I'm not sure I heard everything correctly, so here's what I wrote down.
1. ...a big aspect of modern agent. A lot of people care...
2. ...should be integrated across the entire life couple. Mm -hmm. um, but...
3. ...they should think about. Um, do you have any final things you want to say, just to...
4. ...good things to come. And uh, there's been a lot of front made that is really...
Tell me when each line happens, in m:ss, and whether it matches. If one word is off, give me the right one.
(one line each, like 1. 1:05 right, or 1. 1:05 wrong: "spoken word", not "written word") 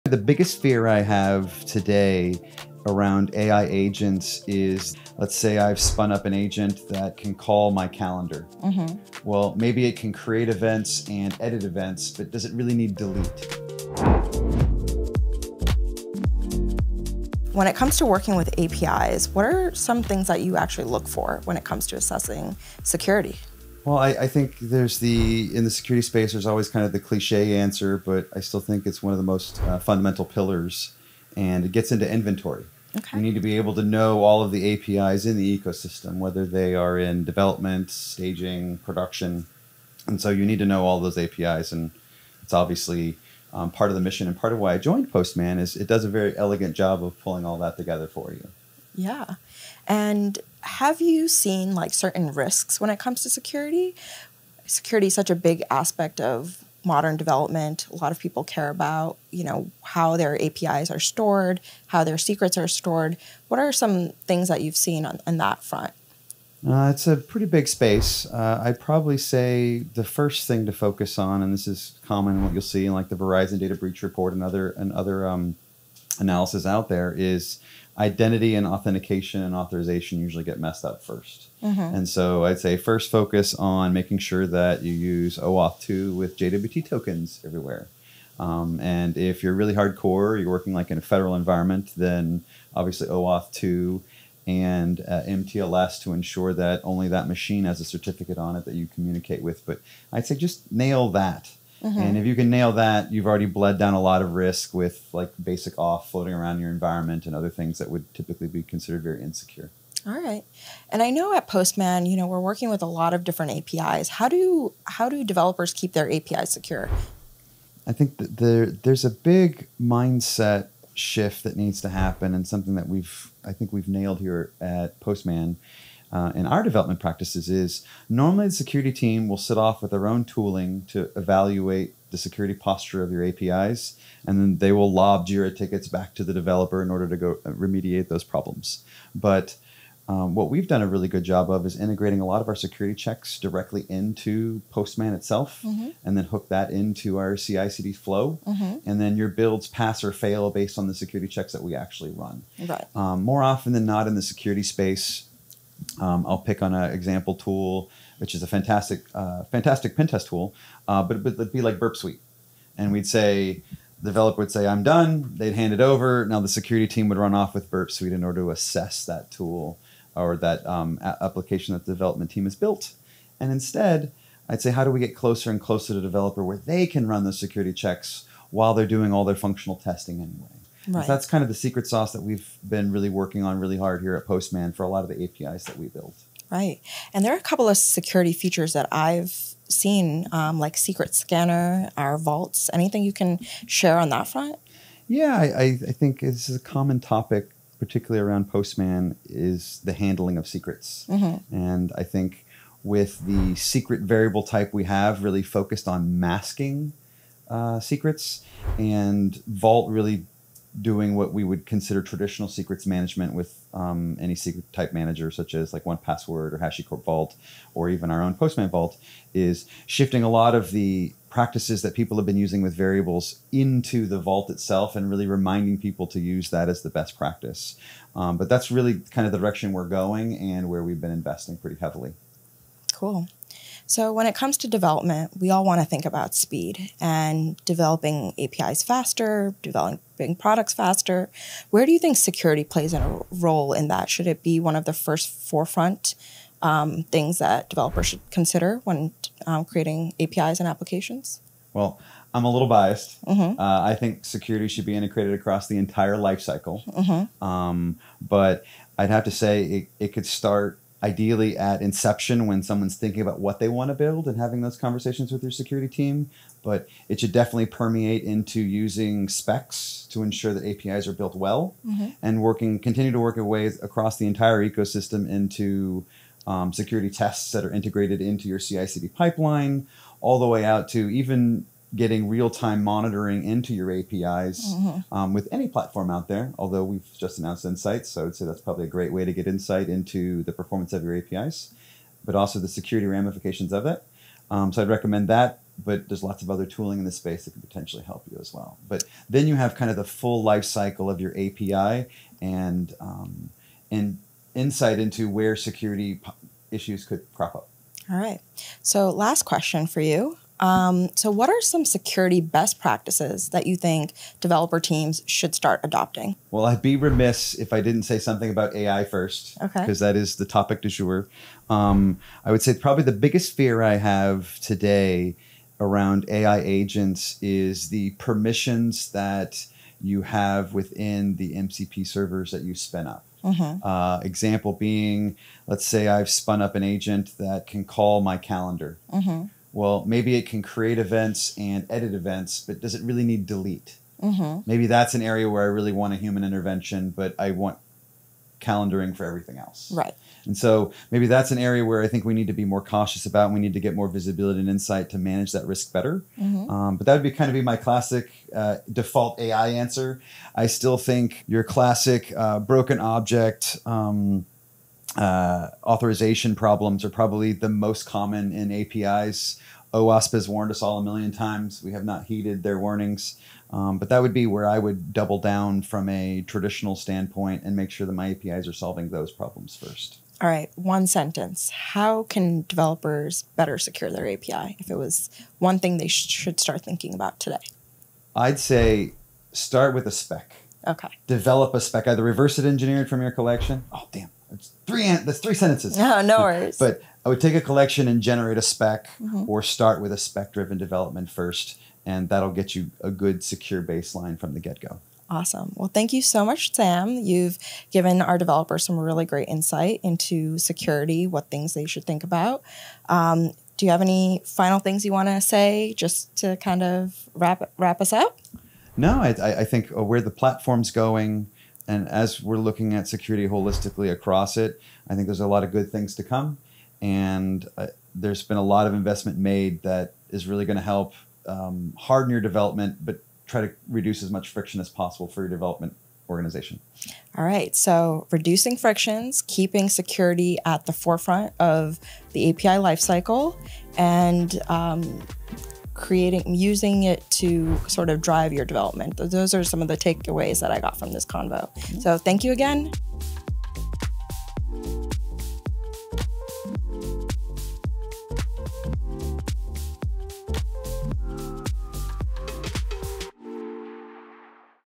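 1. 0:55 wrong: "development", not "agent"
2. 4:14 wrong: "cycle", not "couple"
3. 6:51 right
4. 7:05 wrong: "investment", not "front".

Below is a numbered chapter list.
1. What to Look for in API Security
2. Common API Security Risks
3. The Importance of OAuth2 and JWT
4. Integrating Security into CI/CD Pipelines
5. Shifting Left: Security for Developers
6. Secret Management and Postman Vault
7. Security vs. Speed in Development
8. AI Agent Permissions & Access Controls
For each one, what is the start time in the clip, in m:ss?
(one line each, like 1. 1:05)
1. 0:17
2. 0:49
3. 1:21
4. 2:00
5. 3:06
6. 3:51
7. 4:55
8. 6:01.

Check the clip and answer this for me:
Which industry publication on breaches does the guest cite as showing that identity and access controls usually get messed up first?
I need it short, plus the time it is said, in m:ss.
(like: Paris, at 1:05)
Verizon data breach report, at 1:13.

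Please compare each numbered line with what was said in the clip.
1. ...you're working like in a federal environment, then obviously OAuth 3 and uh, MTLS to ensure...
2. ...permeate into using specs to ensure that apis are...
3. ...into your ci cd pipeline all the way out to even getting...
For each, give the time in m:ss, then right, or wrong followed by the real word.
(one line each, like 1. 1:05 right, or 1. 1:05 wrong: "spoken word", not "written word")
1. 1:30 wrong: "2", not "3"
2. 4:27 right
3. 4:38 right.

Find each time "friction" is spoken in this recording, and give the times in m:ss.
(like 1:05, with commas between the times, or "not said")
7:14, 7:18.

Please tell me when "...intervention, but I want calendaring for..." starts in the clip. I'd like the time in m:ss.
5:46.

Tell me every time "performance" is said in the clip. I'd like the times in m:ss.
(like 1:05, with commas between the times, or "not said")
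4:50.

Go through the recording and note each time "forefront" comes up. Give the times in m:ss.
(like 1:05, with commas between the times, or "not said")
4:05, 7:20.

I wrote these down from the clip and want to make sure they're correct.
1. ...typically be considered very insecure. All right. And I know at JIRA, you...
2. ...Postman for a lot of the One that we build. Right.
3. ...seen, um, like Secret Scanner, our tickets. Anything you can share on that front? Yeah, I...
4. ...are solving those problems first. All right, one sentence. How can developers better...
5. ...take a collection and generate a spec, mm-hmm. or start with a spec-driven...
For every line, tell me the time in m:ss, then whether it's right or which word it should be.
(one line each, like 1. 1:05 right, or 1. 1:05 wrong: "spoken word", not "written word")
1. 1:48 wrong: "Postman", not "JIRA"
2. 3:04 wrong: "APIs", not "One"
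3. 3:09 wrong: "vaults", not "tickets"
4. 6:18 right
5. 6:37 right.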